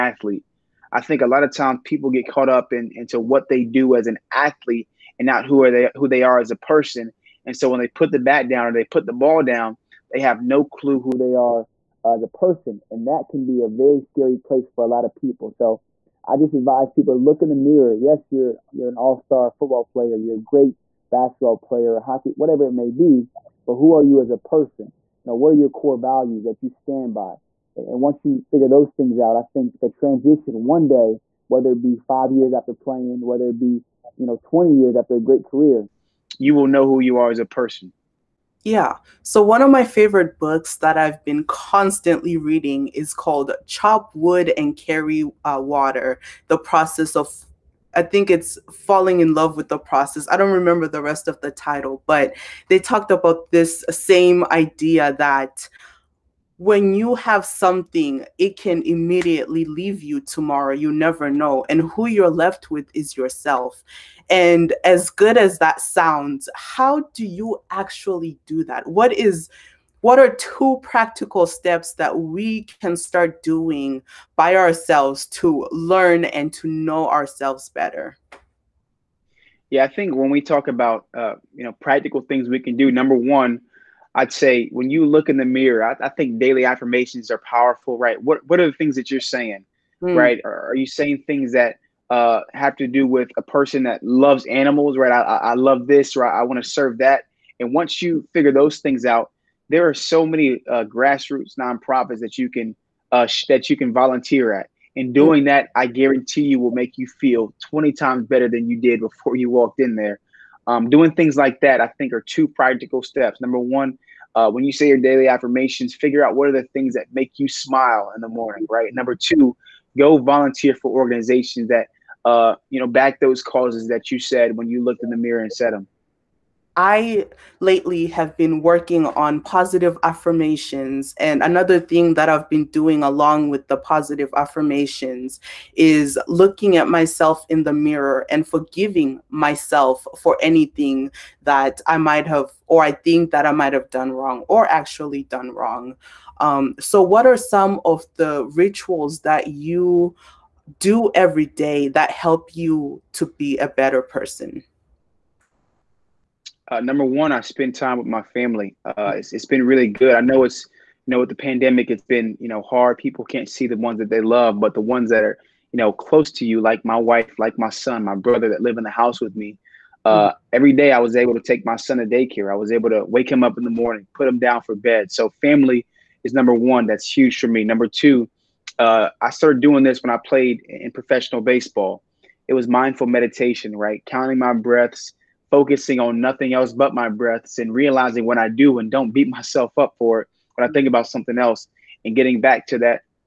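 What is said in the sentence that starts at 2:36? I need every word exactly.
uh, number one, I spend time with my family.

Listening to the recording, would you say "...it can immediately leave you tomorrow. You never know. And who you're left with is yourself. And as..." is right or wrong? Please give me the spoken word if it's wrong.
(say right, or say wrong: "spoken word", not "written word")
right.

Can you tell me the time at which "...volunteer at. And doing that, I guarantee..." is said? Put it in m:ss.
1:43.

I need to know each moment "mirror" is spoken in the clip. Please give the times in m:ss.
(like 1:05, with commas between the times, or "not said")
0:17, 1:25, 2:05, 2:17.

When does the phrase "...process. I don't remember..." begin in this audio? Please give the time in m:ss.
0:49.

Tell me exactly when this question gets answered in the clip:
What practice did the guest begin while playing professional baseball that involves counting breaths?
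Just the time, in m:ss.
3:02.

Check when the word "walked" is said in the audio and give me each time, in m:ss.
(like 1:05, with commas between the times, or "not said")
1:49.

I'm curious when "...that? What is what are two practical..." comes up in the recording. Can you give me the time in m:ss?
1:08.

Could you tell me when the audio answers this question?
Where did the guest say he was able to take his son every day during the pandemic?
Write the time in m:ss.
2:52.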